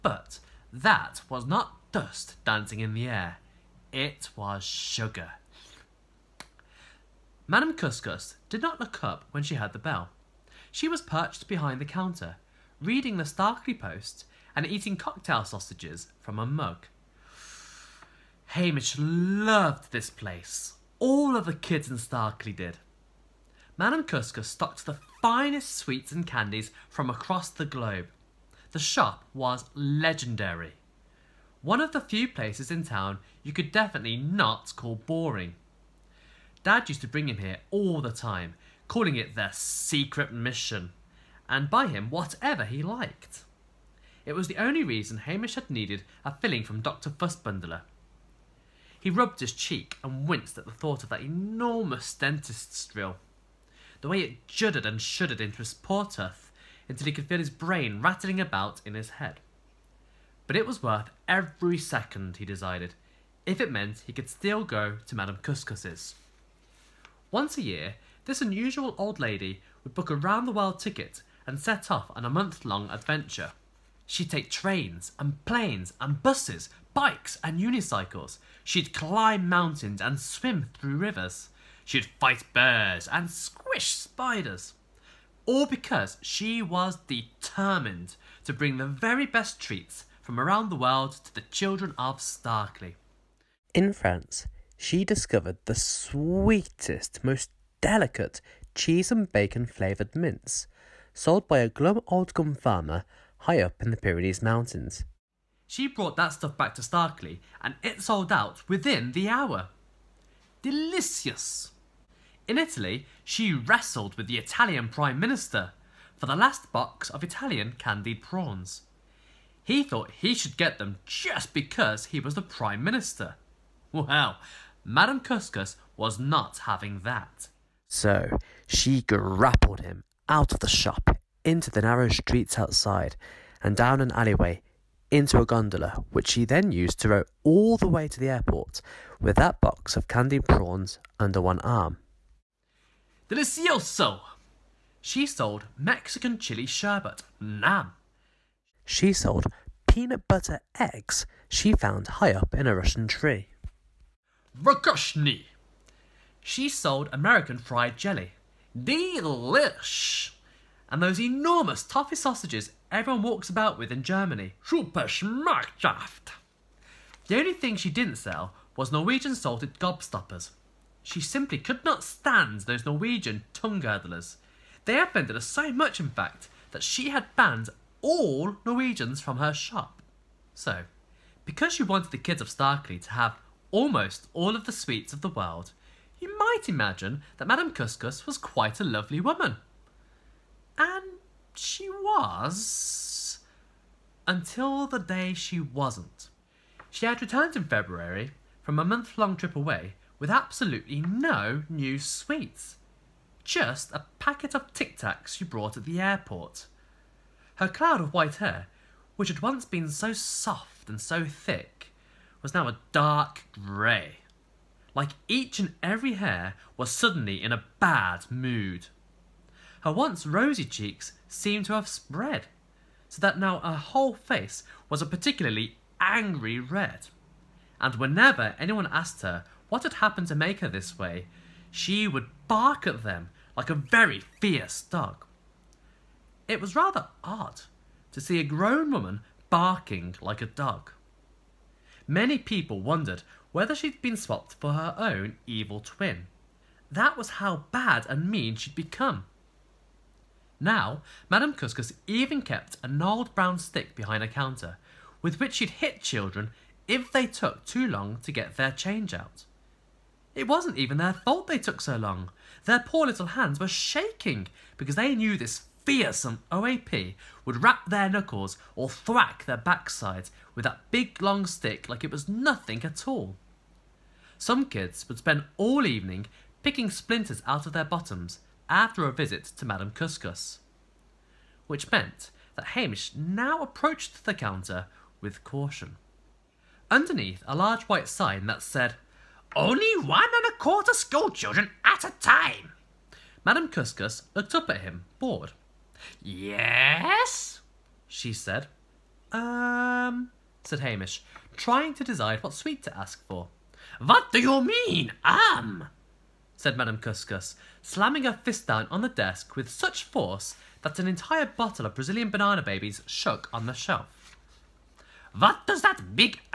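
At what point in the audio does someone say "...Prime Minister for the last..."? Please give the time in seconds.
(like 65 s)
114 s.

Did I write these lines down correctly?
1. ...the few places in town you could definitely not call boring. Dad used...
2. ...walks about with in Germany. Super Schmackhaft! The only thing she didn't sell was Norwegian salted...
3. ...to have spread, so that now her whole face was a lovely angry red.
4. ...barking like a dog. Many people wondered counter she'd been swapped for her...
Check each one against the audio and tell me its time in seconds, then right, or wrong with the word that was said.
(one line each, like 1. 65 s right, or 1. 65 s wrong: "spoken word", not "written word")
1. 31 s right
2. 163 s right
3. 221 s wrong: "particularly", not "lovely"
4. 239 s wrong: "whether", not "counter".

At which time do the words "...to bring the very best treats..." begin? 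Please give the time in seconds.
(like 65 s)
88 s.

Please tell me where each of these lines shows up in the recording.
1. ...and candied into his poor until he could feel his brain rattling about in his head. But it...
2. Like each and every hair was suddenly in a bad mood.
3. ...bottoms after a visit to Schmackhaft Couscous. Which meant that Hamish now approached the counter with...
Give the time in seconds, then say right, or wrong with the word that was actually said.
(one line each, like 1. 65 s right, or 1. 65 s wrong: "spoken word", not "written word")
1. 54 s wrong: "shuddered", not "candied"
2. 214 s right
3. 277 s wrong: "Madame", not "Schmackhaft".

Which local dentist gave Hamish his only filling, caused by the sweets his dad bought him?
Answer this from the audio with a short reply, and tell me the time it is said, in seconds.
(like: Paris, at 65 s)
Dr. Fussbundler, at 46 s.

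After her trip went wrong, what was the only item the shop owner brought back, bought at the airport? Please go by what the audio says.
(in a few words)
Tic Tacs.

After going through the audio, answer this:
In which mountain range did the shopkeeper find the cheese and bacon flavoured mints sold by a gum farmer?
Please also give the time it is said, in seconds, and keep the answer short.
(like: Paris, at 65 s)
Pyrenees Mountains, at 103 s.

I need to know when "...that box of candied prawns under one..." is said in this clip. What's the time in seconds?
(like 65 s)
139 s.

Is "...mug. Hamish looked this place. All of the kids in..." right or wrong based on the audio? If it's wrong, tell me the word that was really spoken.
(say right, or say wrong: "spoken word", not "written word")
wrong: "loved", not "looked".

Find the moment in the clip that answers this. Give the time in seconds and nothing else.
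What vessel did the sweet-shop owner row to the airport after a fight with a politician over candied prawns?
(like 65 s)
135 s.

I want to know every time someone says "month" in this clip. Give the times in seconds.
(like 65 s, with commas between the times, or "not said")
72 s, 198 s.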